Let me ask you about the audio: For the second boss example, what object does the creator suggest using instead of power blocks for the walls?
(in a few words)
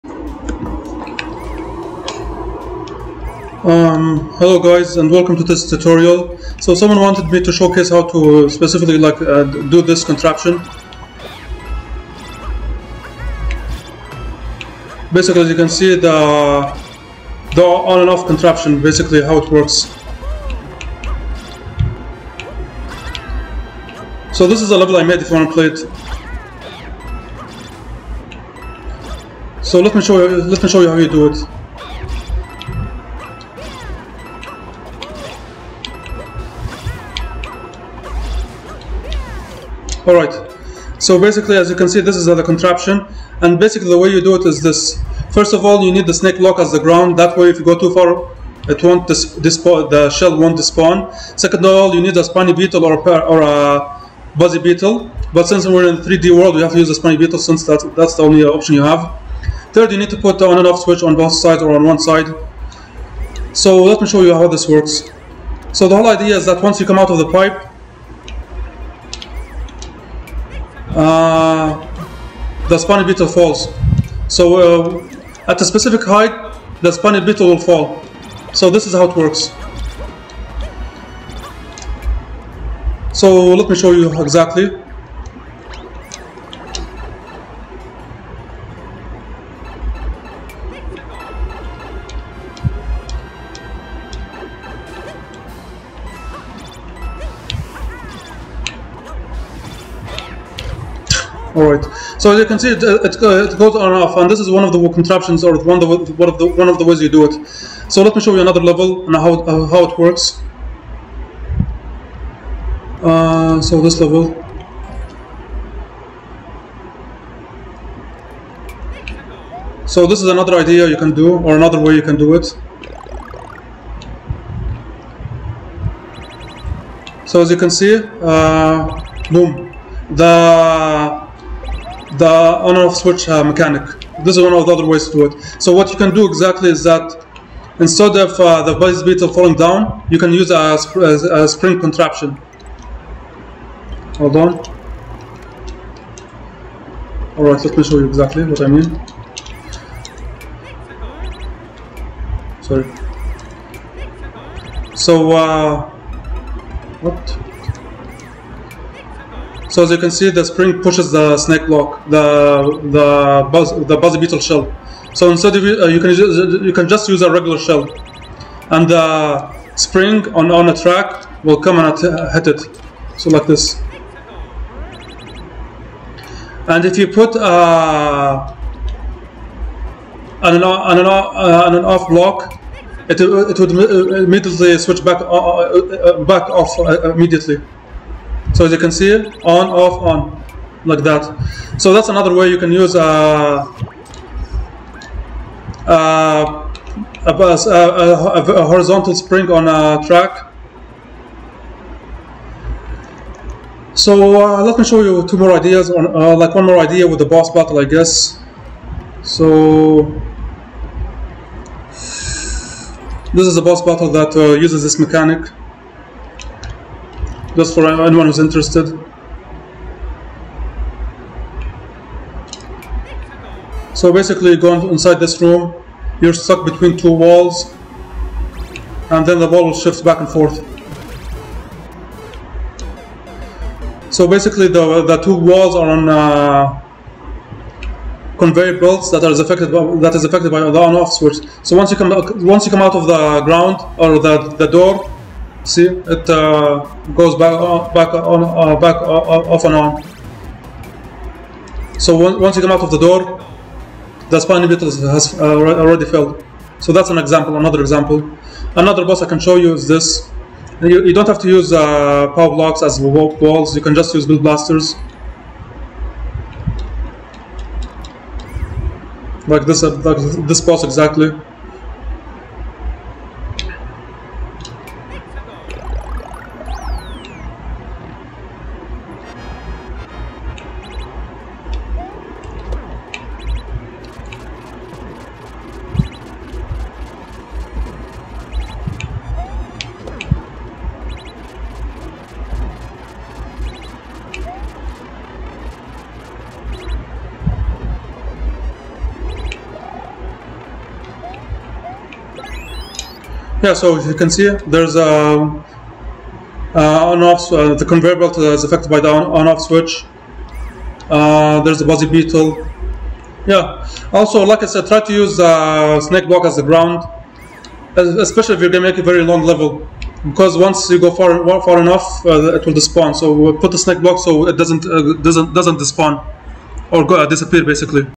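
Bill Blasters.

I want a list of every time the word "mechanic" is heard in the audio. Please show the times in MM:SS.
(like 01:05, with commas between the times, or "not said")
02:13, 03:34.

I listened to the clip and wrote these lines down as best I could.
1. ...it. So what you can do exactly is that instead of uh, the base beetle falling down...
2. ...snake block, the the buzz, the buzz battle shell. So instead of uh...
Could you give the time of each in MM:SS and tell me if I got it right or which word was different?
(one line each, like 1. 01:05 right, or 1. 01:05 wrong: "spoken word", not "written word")
1. 02:15 right
2. 02:41 wrong: "beetle", not "battle".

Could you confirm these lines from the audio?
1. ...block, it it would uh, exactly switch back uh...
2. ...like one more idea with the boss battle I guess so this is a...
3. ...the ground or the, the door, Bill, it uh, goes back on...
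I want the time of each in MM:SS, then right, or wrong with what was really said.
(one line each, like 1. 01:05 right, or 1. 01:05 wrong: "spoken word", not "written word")
1. 03:02 wrong: "immediately", not "exactly"
2. 03:26 right
3. 04:03 wrong: "See", not "Bill".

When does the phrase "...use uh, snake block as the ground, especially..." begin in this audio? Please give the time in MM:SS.
05:15.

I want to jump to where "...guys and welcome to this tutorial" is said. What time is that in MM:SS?
00:04.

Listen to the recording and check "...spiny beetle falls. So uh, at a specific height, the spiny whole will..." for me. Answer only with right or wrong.
wrong.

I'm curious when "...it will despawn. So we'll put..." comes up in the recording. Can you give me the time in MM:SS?
05:22.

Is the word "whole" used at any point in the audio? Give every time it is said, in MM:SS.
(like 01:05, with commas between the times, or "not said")
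01:05.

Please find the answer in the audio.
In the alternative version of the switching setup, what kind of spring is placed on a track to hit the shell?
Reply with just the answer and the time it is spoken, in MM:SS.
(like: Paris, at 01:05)
Horizontal spring, at 03:18.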